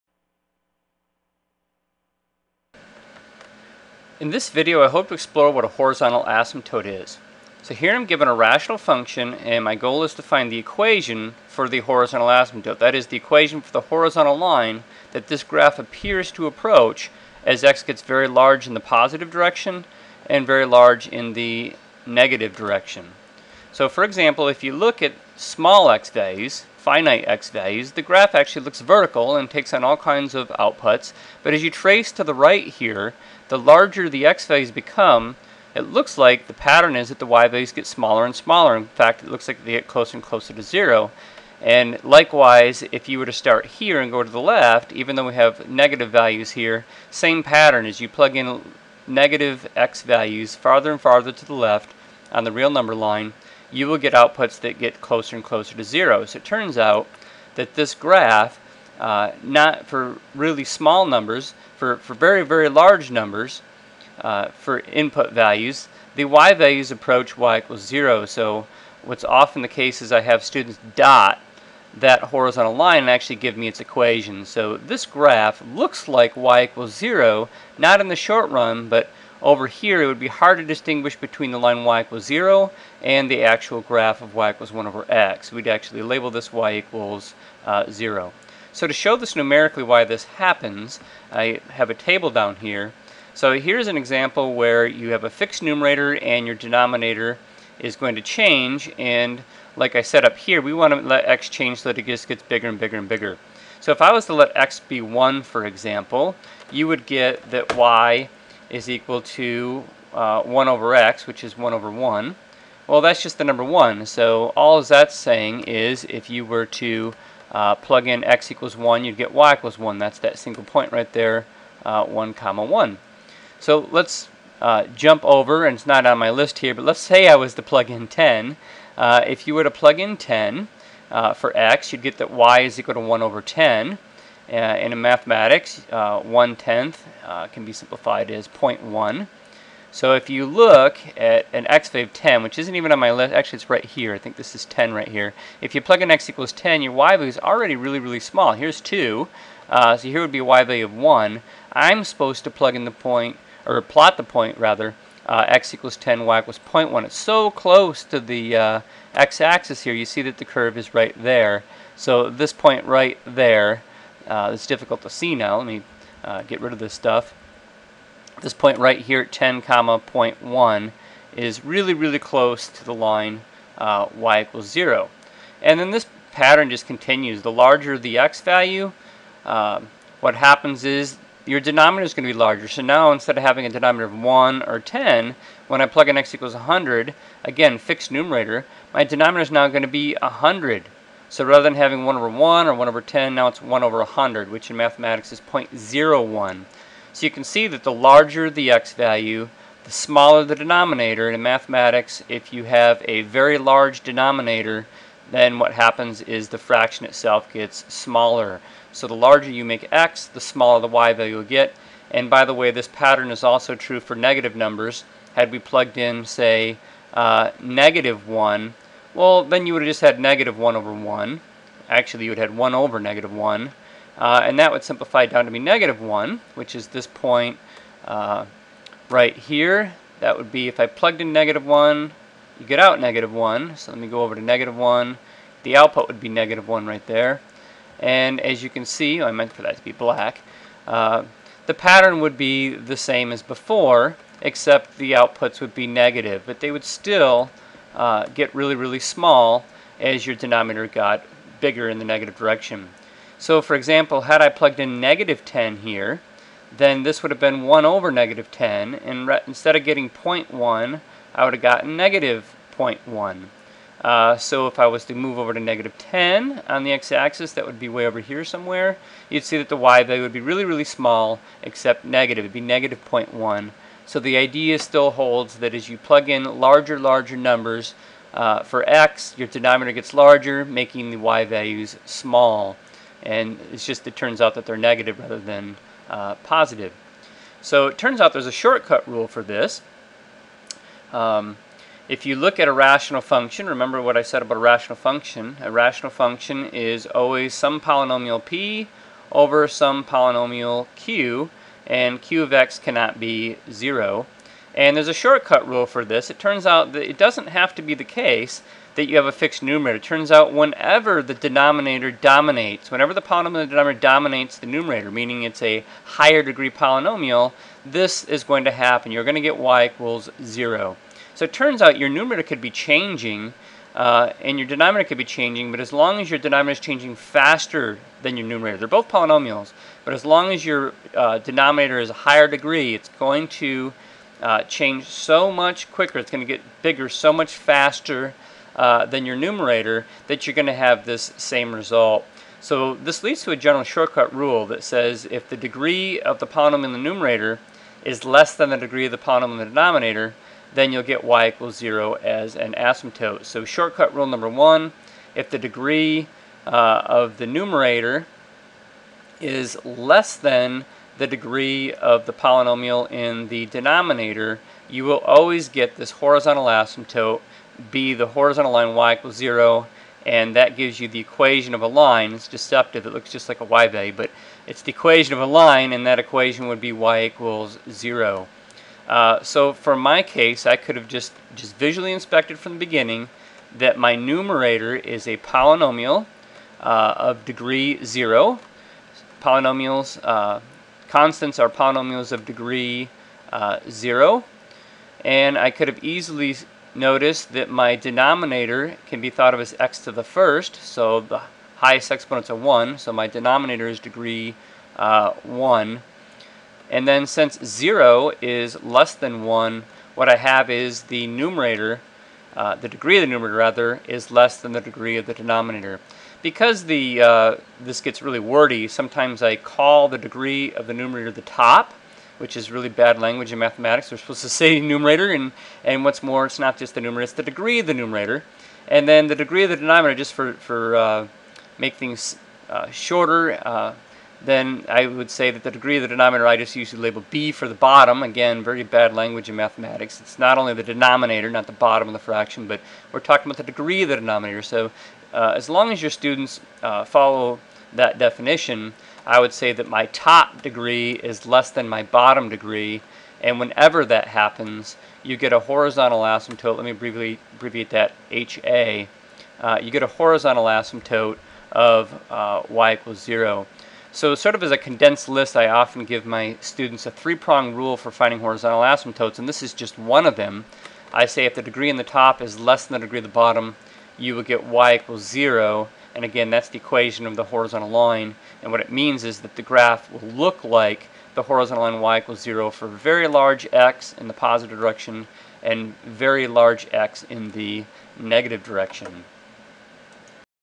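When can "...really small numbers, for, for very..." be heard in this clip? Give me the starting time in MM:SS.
01:00.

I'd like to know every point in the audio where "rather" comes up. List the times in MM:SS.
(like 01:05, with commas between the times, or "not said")
02:34, 03:11, 04:45, 06:53.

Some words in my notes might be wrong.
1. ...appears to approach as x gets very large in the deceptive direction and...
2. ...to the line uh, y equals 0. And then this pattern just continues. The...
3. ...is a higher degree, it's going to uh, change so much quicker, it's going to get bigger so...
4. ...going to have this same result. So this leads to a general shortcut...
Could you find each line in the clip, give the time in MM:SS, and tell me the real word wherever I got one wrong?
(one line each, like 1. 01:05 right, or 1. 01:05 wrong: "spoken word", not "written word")
1. 00:15 wrong: "positive", not "deceptive"
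2. 02:52 right
3. 05:31 right
4. 05:40 right.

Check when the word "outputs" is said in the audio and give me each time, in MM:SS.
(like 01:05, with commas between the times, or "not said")
00:30, 00:54, 03:55, 04:05.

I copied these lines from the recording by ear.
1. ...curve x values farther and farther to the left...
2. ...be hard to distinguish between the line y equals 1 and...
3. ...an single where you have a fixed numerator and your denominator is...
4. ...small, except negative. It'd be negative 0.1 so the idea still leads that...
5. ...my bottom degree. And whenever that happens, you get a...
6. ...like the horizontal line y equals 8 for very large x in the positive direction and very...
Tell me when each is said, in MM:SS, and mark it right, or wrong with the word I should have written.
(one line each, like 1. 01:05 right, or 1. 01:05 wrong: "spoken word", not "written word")
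1. 00:49 wrong: "negative", not "curve"
2. 01:20 wrong: "0", not "1"
3. 01:33 wrong: "example", not "single"
4. 04:30 wrong: "holds", not "leads"
5. 07:31 right
6. 08:00 wrong: "0", not "8".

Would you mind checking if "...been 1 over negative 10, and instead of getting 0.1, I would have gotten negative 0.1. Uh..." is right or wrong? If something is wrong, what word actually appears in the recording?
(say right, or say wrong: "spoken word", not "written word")
right.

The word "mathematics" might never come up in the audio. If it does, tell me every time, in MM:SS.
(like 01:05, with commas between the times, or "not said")
02:14, 03:14, 03:21, 07:03, 07:19.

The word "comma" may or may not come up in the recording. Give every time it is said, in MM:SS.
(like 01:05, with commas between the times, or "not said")
02:02, 02:49.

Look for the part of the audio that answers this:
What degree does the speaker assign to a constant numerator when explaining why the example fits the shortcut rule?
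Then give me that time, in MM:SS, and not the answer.
06:32.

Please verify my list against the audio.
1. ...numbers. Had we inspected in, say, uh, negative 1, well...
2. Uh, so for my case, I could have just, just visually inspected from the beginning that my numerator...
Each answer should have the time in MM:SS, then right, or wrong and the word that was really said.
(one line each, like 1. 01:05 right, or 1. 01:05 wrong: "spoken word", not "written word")
1. 03:34 wrong: "plugged", not "inspected"
2. 06:19 right.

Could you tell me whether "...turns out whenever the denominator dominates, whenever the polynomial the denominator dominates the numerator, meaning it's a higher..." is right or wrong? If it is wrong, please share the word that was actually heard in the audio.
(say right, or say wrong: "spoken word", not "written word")
right.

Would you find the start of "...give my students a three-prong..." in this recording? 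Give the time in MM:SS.
07:46.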